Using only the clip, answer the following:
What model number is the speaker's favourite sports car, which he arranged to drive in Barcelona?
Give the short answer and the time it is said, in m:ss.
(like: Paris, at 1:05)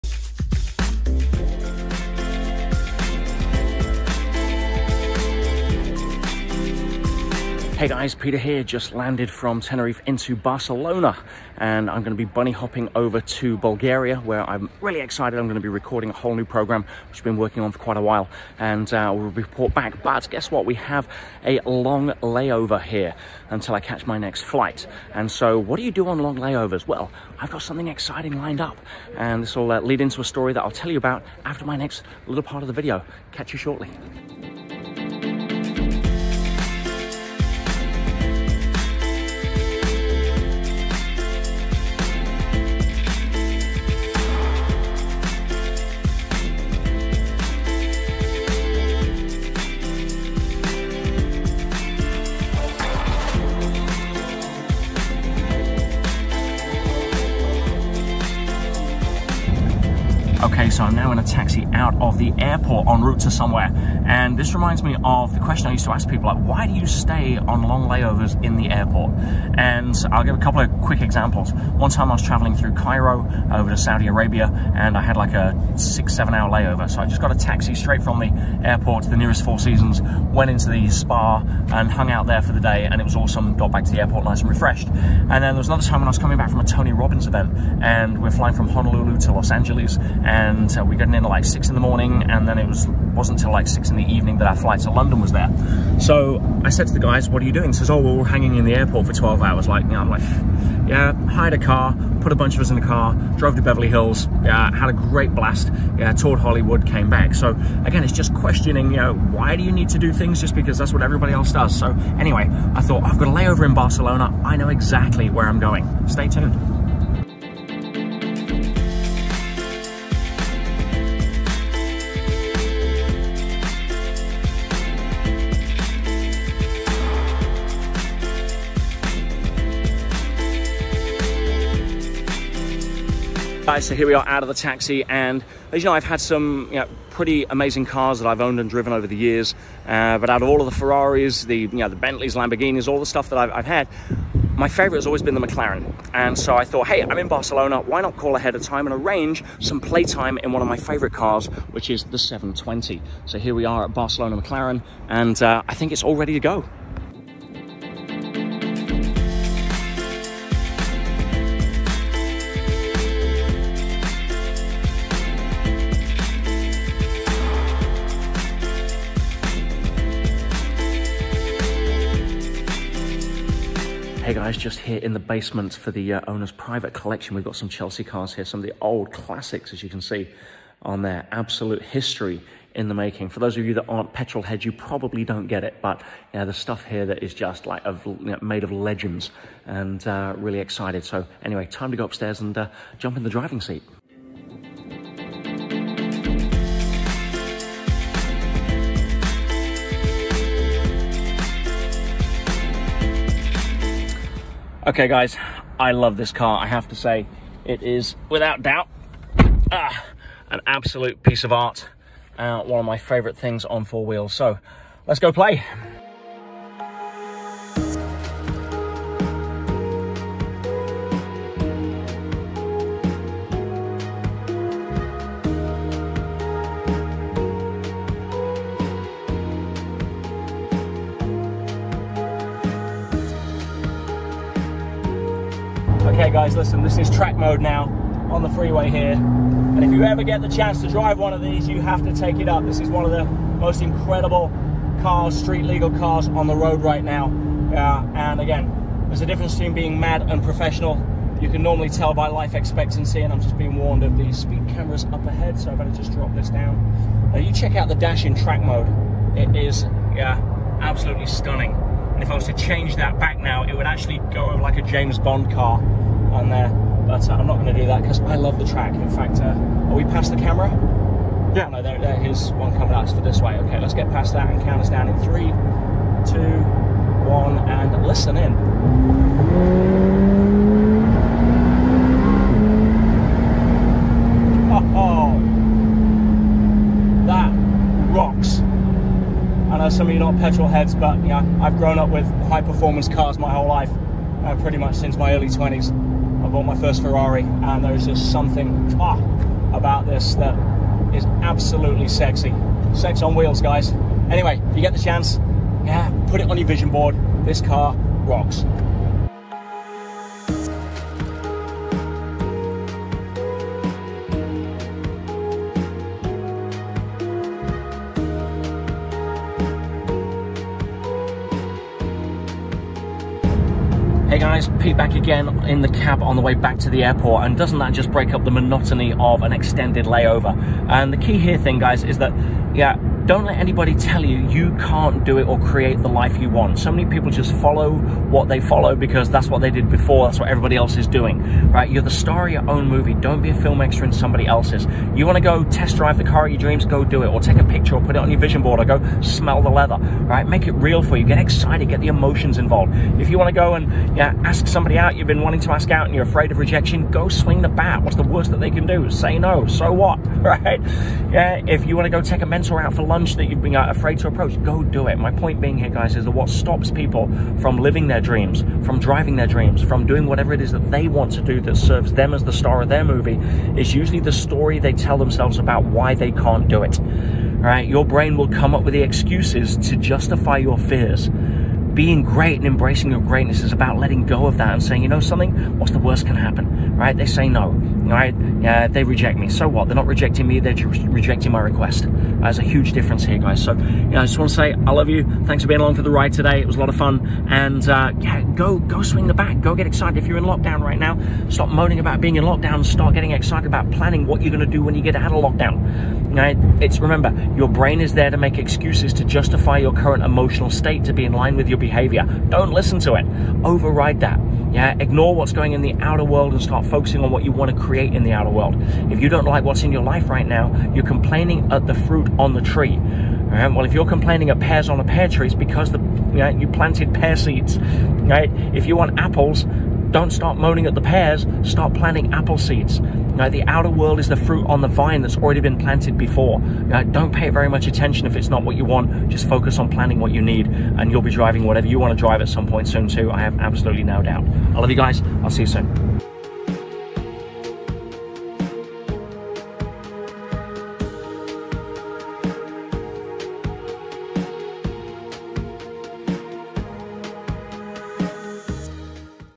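720, at 2:32.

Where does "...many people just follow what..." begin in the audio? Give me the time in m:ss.
5:36.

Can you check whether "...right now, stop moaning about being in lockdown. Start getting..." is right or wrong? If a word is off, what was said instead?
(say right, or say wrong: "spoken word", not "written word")
right.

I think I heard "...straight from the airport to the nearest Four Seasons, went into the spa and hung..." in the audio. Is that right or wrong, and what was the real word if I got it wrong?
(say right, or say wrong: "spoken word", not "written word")
right.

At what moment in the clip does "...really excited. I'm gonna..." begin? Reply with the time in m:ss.
0:14.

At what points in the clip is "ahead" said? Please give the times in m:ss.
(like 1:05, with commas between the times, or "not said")
2:28, 4:15.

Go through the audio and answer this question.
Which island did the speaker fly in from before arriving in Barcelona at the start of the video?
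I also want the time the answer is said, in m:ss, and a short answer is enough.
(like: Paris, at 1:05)
Tenerife, at 0:09.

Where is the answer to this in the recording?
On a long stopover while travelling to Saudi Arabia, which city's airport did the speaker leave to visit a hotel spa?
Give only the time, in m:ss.
1:12.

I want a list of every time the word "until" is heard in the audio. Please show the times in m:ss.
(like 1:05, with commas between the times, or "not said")
0:23, 1:33.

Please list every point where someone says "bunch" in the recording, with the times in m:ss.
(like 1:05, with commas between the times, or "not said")
1:42.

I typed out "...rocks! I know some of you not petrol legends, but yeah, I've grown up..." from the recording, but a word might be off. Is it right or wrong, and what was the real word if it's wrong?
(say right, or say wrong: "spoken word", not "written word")
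wrong: "heads", not "legends".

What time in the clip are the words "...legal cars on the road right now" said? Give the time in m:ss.
4:05.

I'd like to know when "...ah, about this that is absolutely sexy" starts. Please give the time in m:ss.
4:58.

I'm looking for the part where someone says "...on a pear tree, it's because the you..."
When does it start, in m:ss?
7:04.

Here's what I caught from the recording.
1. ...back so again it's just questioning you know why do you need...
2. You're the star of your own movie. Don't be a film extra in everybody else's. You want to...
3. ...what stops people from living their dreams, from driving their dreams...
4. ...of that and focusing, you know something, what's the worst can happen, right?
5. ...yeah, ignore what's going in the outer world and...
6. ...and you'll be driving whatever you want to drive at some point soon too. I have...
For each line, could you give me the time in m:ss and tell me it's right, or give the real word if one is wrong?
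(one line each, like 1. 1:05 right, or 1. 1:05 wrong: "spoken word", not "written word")
1. 1:47 right
2. 5:41 wrong: "somebody", not "everybody"
3. 6:06 right
4. 6:24 wrong: "saying", not "focusing"
5. 6:54 right
6. 7:20 right.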